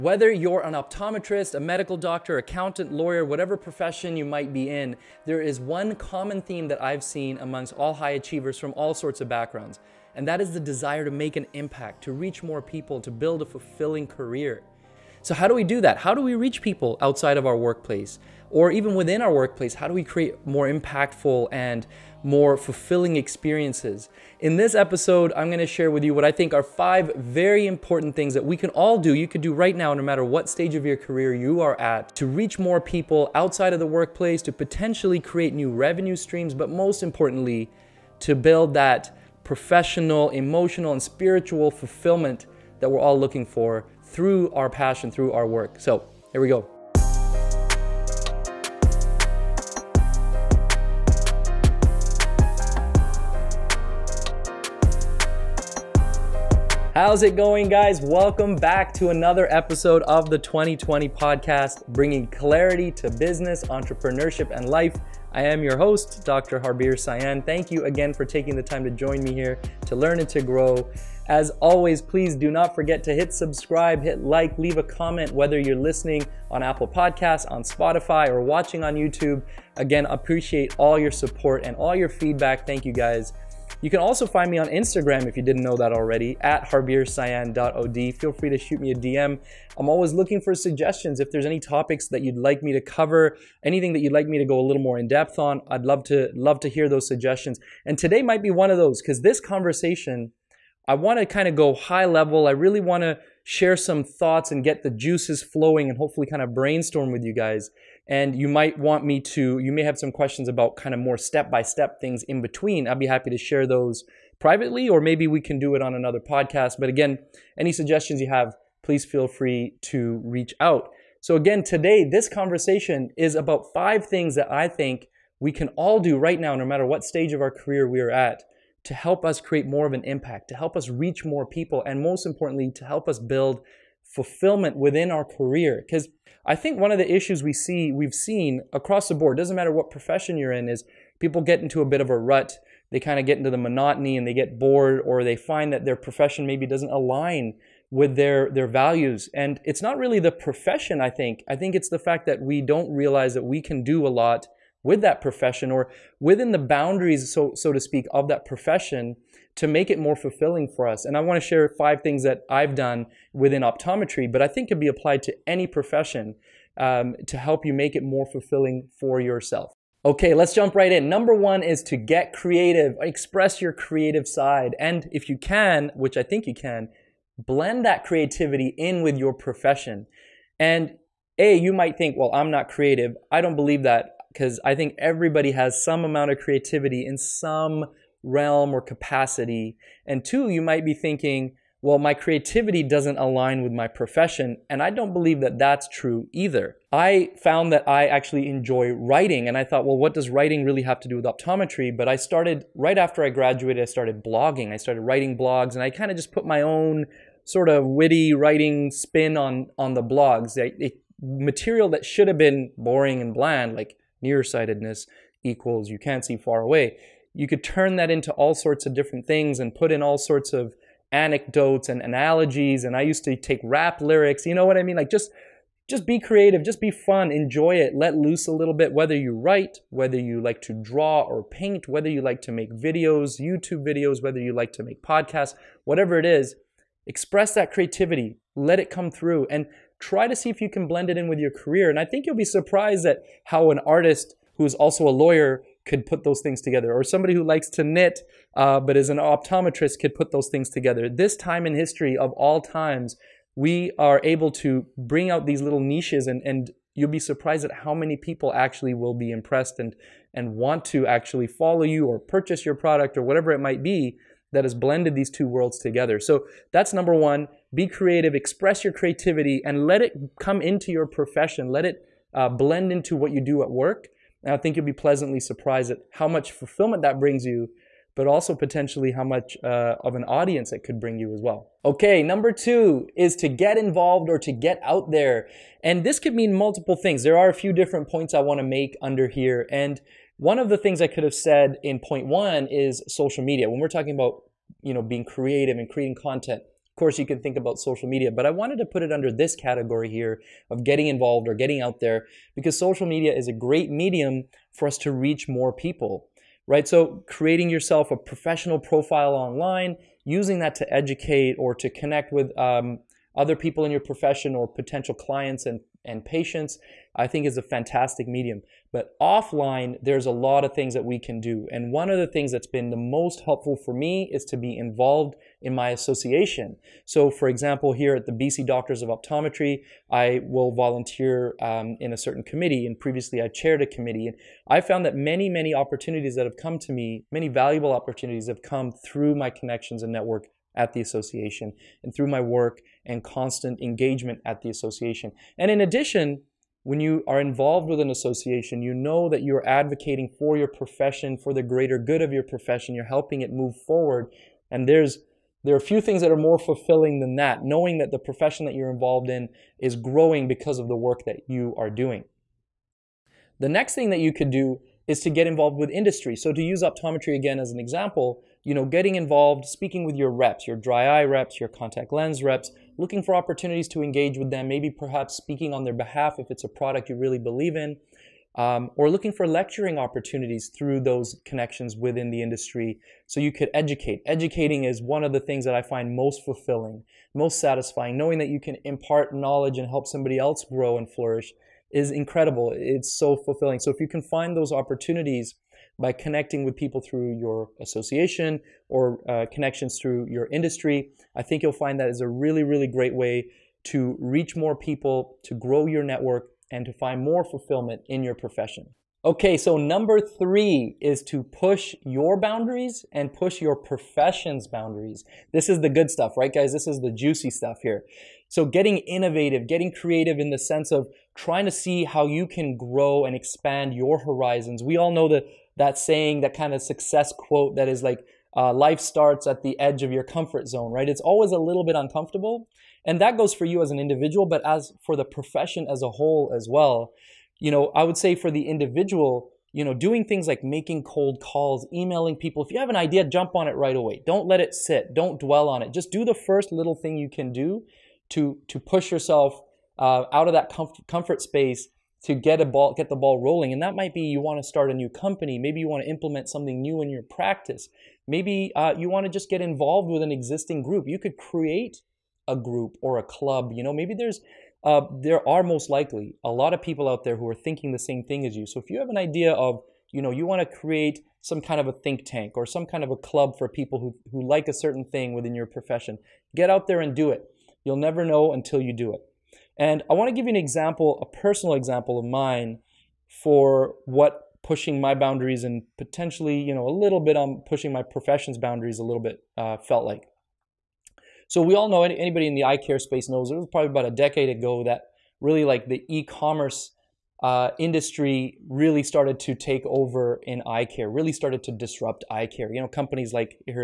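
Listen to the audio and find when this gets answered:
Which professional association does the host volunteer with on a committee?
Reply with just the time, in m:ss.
5:28.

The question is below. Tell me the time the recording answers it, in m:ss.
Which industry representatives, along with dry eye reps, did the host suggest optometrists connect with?
6:11.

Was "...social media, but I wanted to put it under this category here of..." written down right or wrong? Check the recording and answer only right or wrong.
right.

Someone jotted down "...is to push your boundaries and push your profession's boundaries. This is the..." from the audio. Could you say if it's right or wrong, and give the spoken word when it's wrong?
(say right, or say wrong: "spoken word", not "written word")
right.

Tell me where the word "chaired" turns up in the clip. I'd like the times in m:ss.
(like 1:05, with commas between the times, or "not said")
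5:33.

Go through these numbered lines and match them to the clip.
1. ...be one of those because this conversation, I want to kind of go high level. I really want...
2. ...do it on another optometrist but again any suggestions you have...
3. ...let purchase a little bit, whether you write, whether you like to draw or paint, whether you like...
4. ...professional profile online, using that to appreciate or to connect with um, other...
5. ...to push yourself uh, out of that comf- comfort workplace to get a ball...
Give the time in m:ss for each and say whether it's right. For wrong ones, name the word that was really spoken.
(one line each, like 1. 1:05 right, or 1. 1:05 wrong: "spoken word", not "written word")
1. 1:38 right
2. 1:55 wrong: "podcast", not "optometrist"
3. 3:47 wrong: "loose", not "purchase"
4. 5:08 wrong: "educate", not "appreciate"
5. 7:28 wrong: "space", not "workplace".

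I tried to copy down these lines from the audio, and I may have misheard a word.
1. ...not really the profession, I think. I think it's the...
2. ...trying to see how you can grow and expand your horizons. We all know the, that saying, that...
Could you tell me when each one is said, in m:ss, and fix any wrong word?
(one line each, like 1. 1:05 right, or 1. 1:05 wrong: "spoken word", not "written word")
1. 2:29 right
2. 7:01 right.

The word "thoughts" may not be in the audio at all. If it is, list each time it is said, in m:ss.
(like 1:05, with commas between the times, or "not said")
1:44, 3:19.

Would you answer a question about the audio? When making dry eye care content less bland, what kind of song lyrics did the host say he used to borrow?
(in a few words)
Rap lyrics.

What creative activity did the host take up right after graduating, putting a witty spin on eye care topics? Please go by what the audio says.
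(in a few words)
Blogging.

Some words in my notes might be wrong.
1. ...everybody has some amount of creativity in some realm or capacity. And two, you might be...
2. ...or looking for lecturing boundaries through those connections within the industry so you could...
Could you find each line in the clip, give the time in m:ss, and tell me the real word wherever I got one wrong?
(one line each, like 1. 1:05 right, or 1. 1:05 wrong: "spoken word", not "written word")
1. 3:04 right
2. 6:18 wrong: "opportunities", not "boundaries".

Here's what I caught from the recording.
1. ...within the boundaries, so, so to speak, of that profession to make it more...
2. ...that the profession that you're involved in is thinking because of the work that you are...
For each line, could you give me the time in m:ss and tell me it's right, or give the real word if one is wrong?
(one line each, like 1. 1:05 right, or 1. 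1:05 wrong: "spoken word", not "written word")
1. 2:36 right
2. 5:57 wrong: "growing", not "thinking".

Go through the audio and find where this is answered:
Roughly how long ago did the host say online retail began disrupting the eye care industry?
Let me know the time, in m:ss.
8:13.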